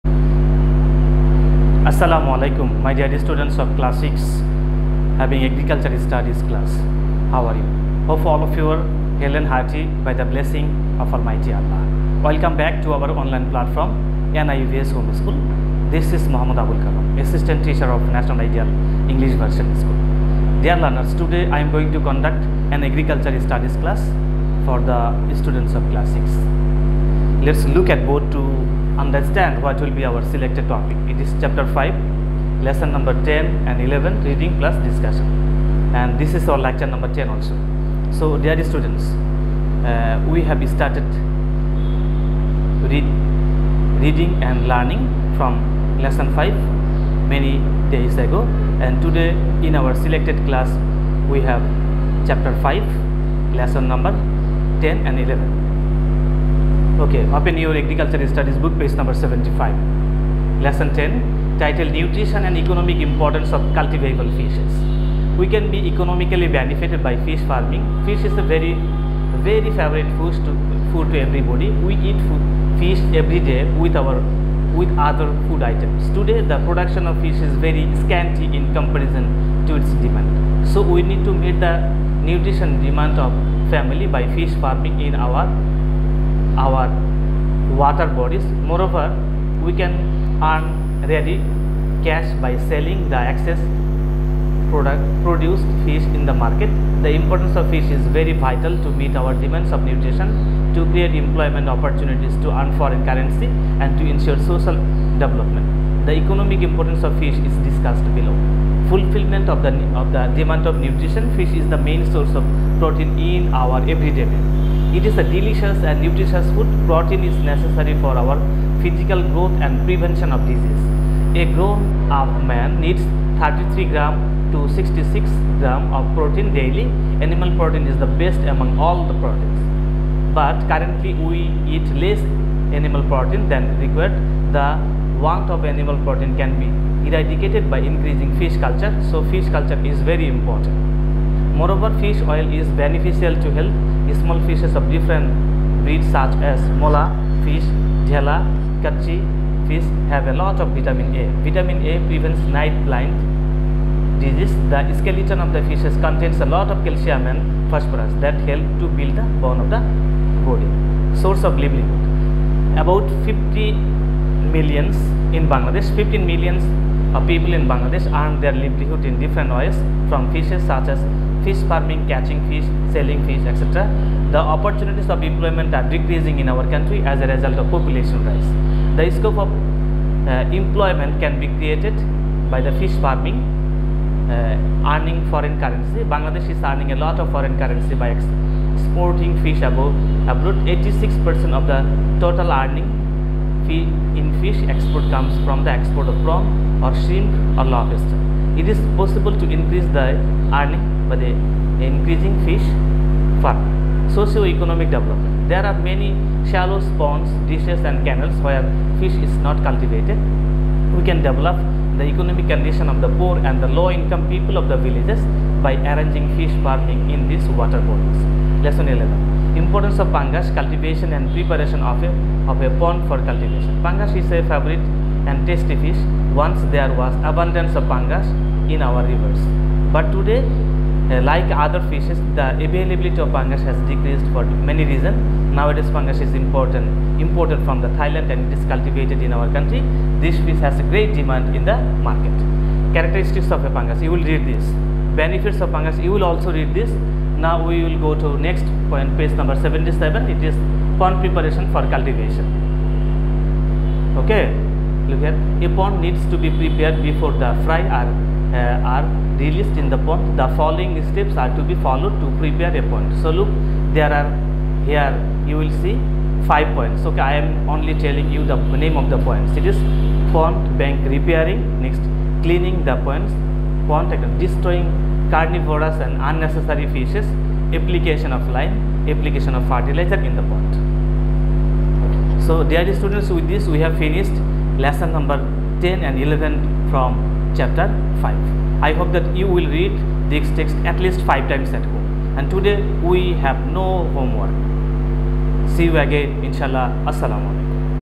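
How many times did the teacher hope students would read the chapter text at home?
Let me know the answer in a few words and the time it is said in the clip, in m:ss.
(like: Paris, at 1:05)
5 times, at 4:51.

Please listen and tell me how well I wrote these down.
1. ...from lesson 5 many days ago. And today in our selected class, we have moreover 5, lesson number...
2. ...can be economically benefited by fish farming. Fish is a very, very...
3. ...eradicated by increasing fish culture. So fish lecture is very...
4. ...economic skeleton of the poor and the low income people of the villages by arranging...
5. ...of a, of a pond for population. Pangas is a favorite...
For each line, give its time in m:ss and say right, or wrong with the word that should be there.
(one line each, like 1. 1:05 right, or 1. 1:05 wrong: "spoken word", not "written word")
1. 0:45 wrong: "chapter", not "moreover"
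2. 1:05 right
3. 2:17 wrong: "culture", not "lecture"
4. 3:32 wrong: "condition", not "skeleton"
5. 3:41 wrong: "cultivation", not "population".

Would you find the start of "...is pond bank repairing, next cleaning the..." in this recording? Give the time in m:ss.
4:29.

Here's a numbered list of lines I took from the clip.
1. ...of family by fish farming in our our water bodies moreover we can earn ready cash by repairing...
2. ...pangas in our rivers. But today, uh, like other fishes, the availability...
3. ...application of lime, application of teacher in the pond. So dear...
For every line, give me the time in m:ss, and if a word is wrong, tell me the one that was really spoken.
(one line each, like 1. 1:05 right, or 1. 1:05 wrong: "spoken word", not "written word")
1. 1:23 wrong: "selling", not "repairing"
2. 3:47 right
3. 4:37 wrong: "fertilizer", not "teacher".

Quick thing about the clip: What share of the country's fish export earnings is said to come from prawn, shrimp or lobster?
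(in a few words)
86%.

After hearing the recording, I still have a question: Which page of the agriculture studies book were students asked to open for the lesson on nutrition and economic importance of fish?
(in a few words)
75.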